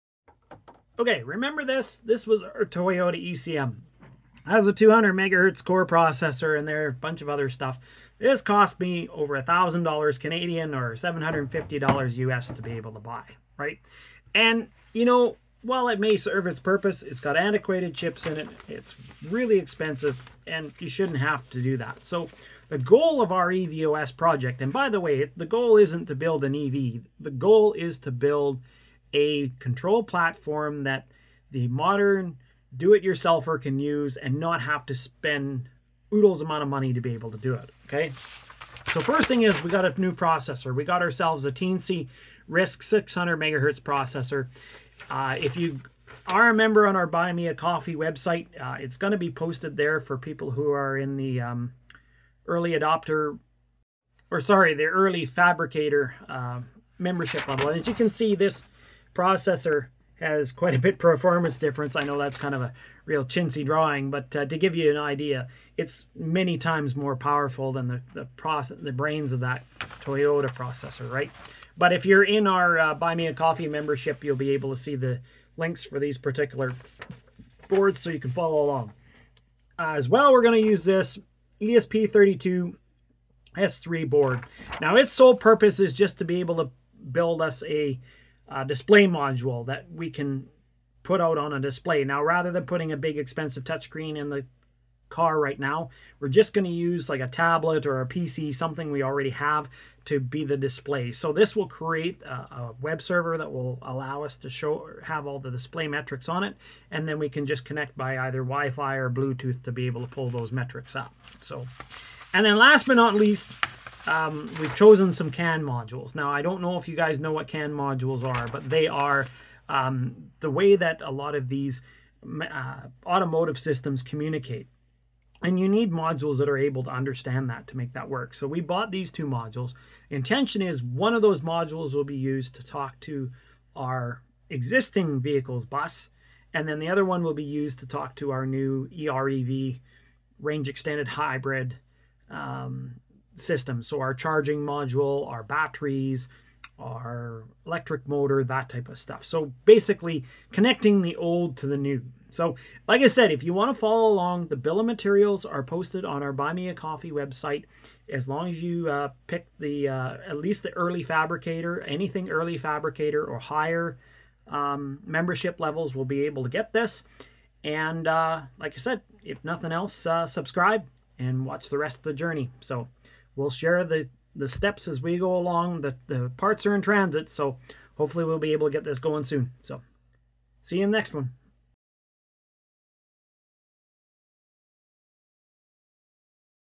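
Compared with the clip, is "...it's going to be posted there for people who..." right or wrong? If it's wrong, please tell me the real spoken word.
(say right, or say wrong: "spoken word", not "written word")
right.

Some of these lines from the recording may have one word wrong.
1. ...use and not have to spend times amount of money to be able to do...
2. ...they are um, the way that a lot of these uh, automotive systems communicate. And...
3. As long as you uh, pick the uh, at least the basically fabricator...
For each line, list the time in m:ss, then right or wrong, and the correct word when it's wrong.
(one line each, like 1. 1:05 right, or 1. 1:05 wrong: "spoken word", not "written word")
1. 0:33 wrong: "oodles", not "times"
2. 1:58 right
3. 2:38 wrong: "early", not "basically".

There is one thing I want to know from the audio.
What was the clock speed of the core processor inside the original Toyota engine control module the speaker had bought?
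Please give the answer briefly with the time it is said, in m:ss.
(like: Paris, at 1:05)
200 MHz, at 0:04.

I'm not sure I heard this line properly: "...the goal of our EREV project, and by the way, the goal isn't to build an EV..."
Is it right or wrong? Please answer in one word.
wrong.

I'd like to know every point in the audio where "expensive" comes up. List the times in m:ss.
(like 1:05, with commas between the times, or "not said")
0:19, 1:33.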